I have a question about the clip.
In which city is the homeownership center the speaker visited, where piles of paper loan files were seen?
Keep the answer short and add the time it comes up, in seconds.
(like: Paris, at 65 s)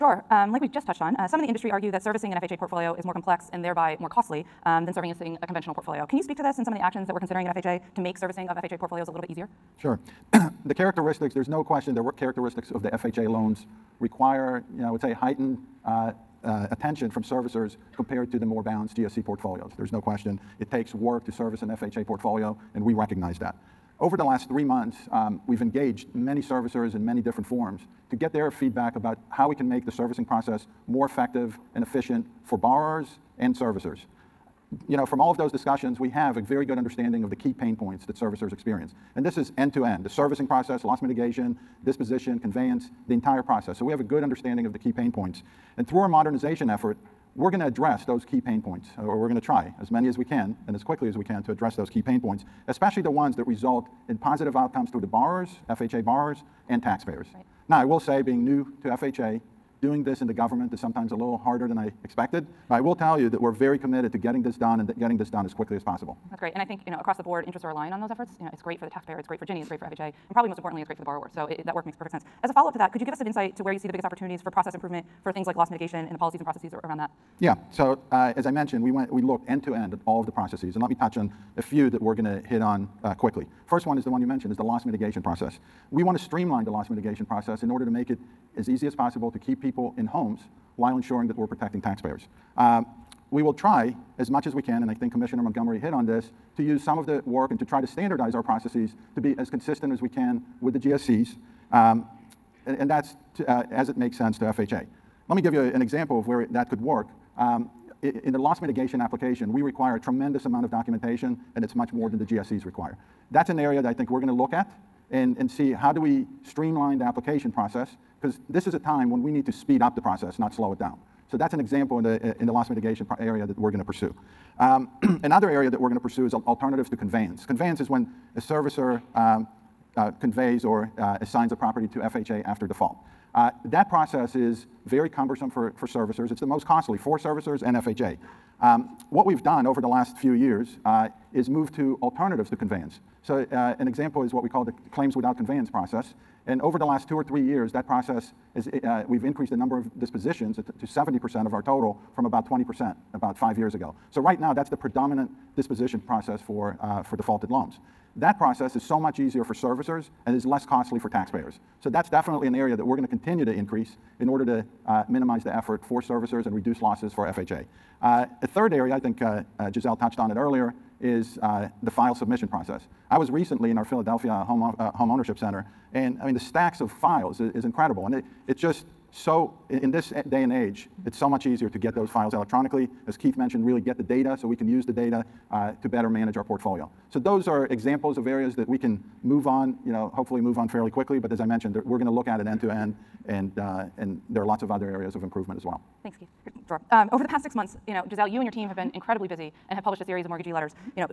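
Philadelphia, at 173 s.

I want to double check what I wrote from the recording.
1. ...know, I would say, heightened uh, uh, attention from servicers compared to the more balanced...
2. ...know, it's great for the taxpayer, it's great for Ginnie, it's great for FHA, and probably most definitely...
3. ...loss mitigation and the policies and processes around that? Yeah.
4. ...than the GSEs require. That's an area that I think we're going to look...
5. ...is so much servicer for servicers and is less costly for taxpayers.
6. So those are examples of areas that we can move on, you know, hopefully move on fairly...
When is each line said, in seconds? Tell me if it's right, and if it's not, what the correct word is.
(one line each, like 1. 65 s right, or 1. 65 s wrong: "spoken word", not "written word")
1. 14 s right
2. 68 s wrong: "importantly", not "definitely"
3. 75 s right
4. 112 s right
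5. 158 s wrong: "easier", not "servicer"
6. 187 s right.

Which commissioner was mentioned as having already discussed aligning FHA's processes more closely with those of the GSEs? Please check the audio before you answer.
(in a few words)
Commissioner Montgomery.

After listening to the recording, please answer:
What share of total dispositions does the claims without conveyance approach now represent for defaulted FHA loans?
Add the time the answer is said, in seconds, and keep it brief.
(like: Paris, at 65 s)
70%, at 150 s.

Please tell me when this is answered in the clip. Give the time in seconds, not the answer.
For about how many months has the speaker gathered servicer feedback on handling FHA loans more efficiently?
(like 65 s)
24 s.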